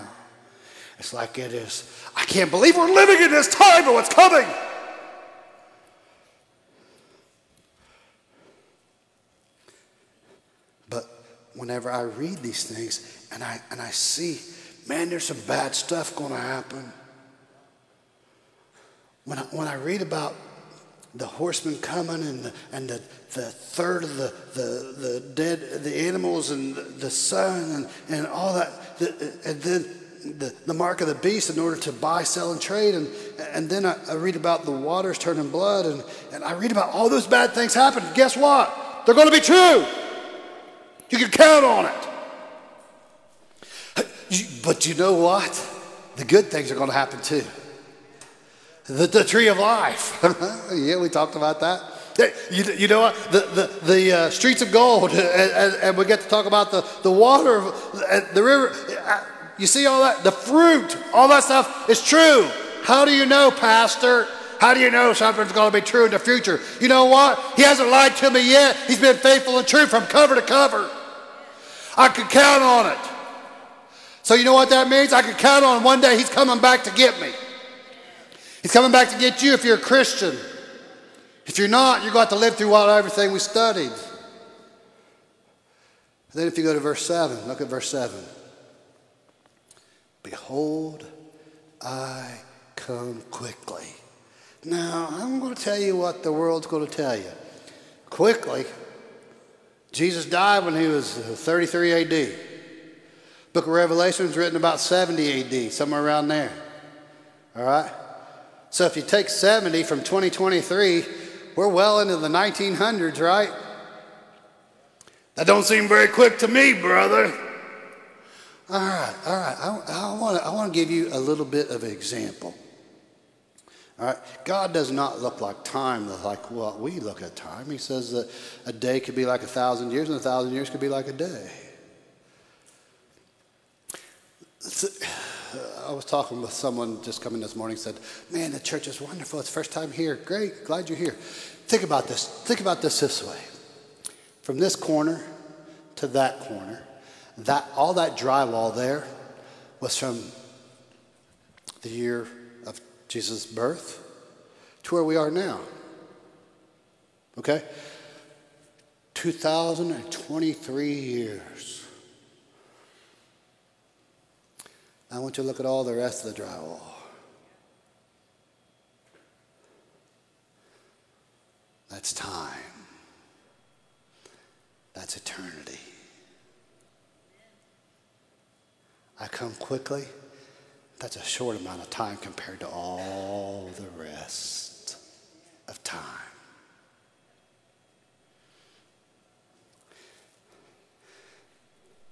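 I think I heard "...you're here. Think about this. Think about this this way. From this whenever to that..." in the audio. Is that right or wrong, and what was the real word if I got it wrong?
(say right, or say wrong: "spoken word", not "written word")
wrong: "corner", not "whenever".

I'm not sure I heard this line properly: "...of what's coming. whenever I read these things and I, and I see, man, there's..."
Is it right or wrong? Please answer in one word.
right.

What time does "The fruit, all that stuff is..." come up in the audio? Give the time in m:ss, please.
1:00.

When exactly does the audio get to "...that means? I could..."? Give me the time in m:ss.
1:14.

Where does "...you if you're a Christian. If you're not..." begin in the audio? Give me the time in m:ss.
1:19.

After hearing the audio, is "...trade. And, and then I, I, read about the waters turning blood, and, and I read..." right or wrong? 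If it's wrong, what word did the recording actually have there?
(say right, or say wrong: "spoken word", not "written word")
right.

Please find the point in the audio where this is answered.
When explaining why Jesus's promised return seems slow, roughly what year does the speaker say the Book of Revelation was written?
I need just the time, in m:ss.
1:44.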